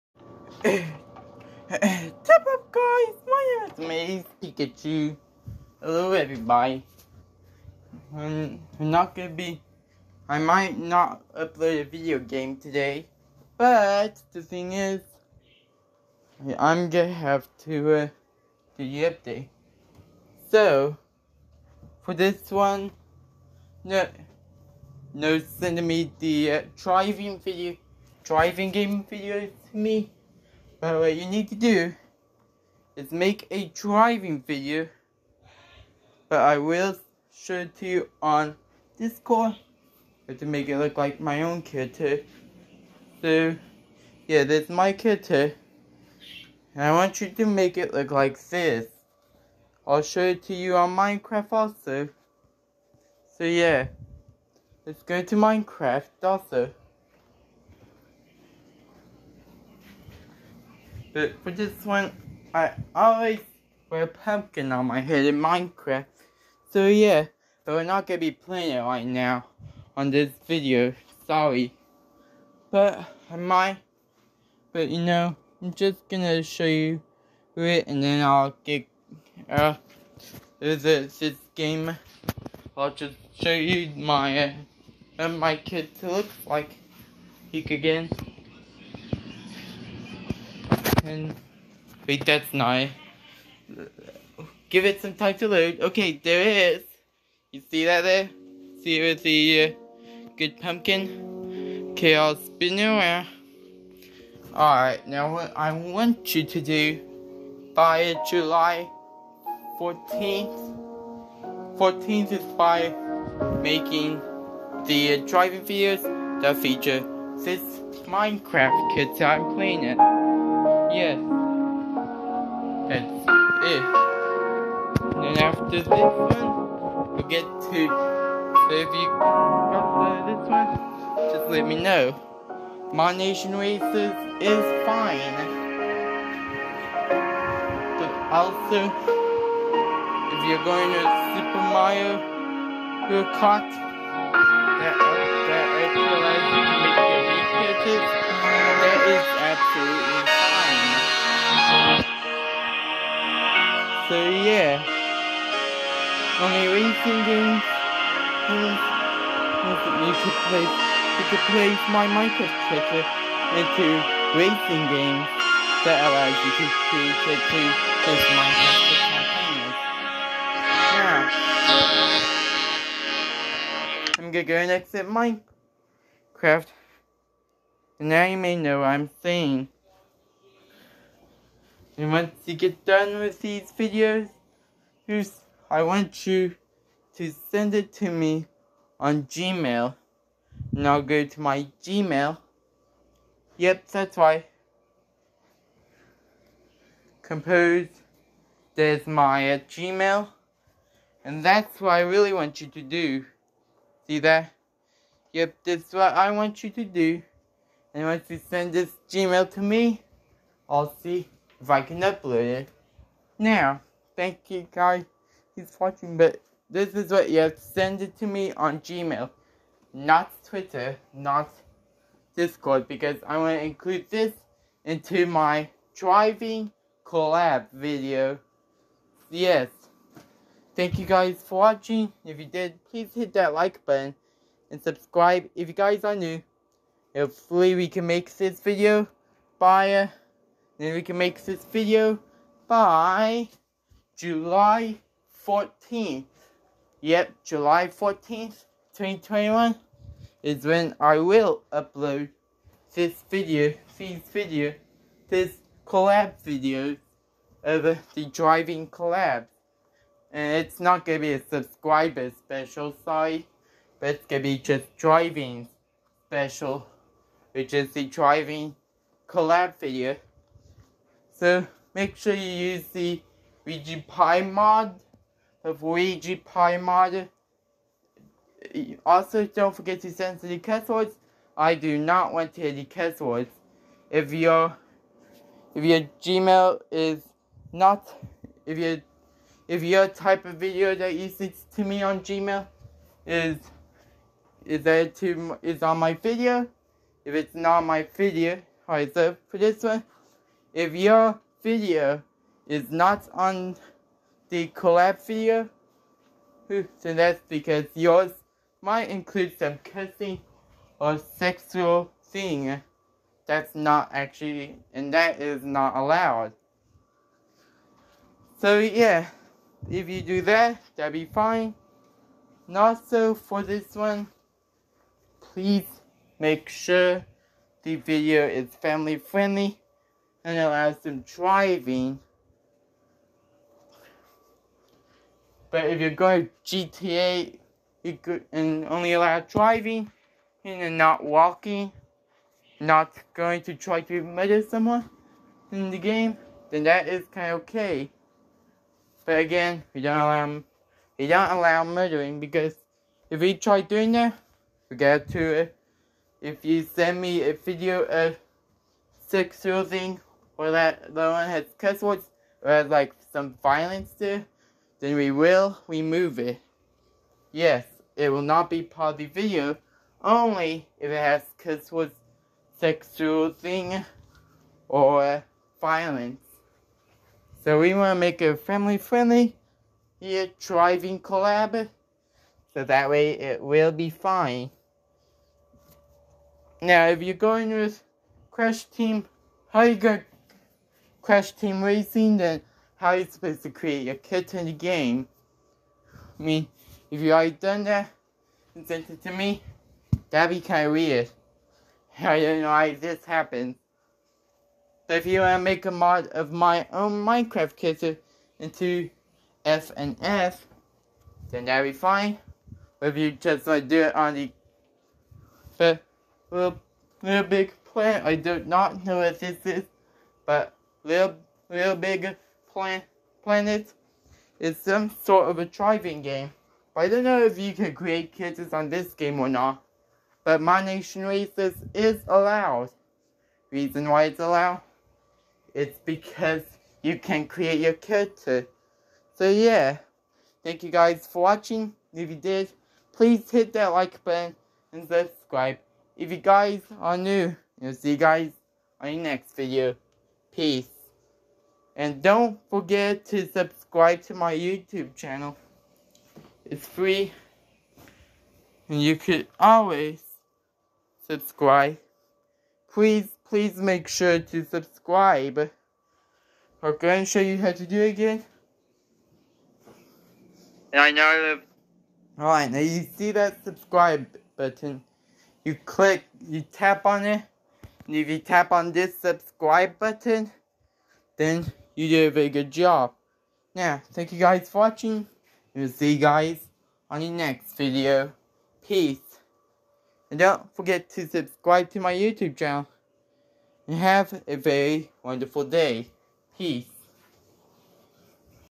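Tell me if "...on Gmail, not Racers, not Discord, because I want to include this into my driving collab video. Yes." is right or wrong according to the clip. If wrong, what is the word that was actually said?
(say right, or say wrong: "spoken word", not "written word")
wrong: "Twitter", not "Racers".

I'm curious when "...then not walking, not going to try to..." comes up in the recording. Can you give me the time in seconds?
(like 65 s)
340 s.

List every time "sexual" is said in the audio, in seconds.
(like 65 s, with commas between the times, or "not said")
311 s, 359 s, 372 s.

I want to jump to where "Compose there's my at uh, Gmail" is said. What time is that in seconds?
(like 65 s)
197 s.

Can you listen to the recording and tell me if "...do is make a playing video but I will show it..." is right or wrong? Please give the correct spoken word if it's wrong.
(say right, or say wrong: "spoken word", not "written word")
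wrong: "driving", not "playing".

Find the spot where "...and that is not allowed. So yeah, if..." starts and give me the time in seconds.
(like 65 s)
314 s.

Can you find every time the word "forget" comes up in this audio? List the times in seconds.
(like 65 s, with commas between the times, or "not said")
279 s, 452 s, 490 s.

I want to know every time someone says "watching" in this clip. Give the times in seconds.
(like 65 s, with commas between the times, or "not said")
215 s, 231 s, 441 s, 484 s.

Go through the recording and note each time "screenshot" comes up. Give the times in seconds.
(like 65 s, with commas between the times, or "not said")
not said.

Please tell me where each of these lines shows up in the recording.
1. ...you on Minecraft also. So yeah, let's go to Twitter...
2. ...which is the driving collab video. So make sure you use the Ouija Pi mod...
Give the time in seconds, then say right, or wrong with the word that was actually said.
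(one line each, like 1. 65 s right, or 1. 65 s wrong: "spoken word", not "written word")
1. 50 s wrong: "Minecraft", not "Twitter"
2. 267 s right.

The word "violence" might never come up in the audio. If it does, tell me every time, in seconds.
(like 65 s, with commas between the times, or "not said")
363 s, 375 s.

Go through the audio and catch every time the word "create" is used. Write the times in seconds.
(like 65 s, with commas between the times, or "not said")
174 s, 393 s, 427 s, 437 s.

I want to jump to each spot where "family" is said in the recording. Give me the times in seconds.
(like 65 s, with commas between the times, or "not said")
328 s, 378 s.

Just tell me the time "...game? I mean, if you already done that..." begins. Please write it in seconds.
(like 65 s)
394 s.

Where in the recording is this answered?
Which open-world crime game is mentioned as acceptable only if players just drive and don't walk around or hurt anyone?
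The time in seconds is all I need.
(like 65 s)
336 s.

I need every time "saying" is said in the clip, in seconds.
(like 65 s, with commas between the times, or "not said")
179 s.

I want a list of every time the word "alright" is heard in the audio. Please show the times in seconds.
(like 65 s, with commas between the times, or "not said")
104 s, 298 s, 472 s.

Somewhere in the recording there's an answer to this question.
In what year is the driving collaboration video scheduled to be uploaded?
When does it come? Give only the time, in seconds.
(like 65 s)
248 s.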